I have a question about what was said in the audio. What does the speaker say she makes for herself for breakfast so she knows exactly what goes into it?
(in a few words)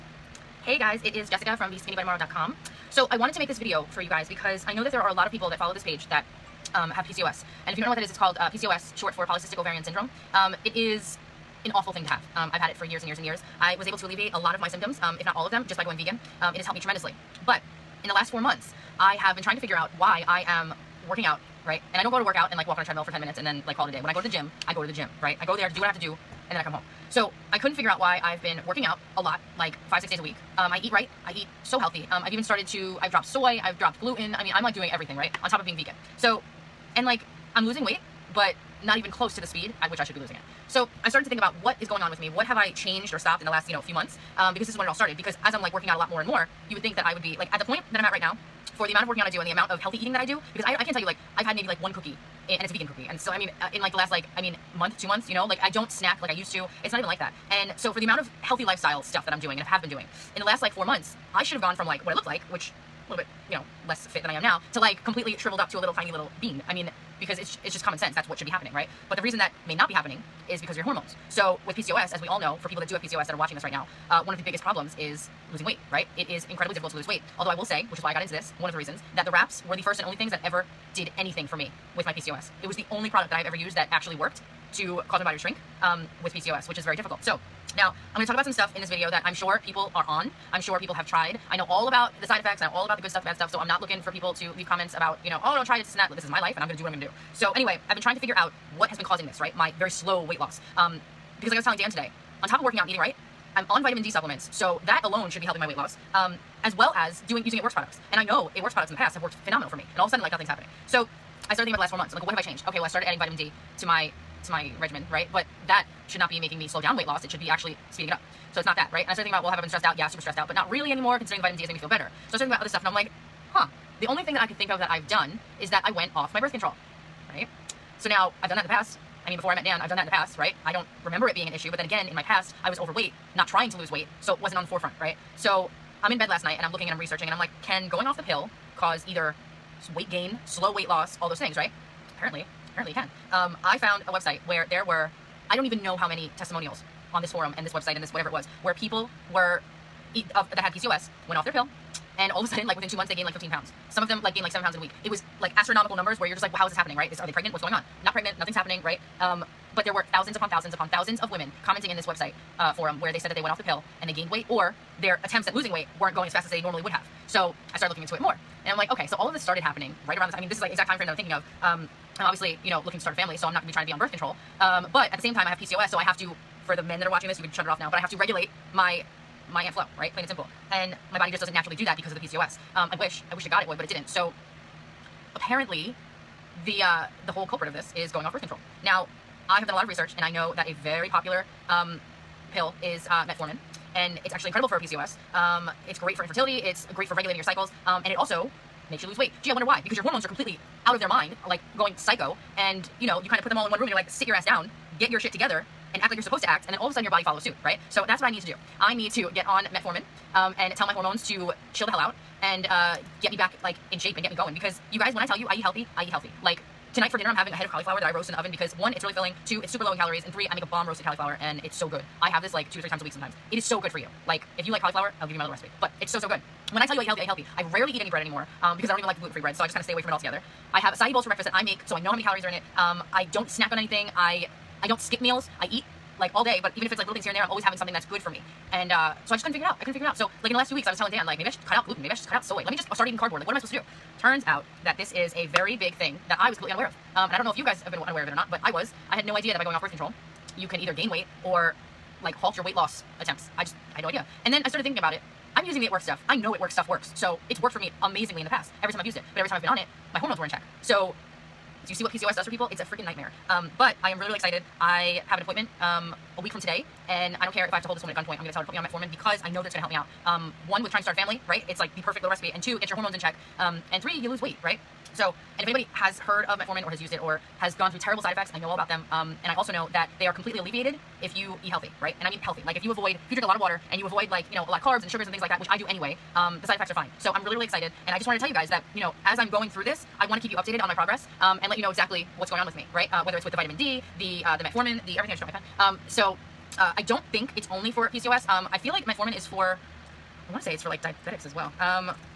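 acai bowls.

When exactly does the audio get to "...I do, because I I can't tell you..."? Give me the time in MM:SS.
00:50.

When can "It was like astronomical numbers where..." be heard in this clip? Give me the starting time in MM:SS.
02:35.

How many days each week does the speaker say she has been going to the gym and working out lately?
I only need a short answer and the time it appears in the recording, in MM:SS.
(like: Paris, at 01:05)
5 or 6, at 00:29.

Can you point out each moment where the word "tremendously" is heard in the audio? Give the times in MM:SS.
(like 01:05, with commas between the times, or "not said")
00:16.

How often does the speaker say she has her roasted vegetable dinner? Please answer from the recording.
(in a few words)
2 to 3 times a week.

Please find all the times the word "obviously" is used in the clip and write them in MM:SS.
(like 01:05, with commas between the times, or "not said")
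02:52.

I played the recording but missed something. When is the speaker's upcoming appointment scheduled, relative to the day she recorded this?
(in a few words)
a week from today.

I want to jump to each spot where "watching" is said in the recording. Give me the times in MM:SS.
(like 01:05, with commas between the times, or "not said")
01:13, 02:57.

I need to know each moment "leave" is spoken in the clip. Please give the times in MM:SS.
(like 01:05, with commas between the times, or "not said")
01:34.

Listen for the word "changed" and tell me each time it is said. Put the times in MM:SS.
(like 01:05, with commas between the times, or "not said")
00:42, 01:52.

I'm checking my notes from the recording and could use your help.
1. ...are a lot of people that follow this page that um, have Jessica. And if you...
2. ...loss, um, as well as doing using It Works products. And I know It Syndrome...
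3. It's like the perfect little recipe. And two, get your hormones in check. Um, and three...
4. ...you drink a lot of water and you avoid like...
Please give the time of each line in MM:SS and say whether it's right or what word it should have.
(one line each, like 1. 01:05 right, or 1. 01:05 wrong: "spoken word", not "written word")
1. 00:05 wrong: "PCOS", not "Jessica"
2. 01:45 wrong: "Works", not "Syndrome"
3. 04:31 right
4. 04:43 right.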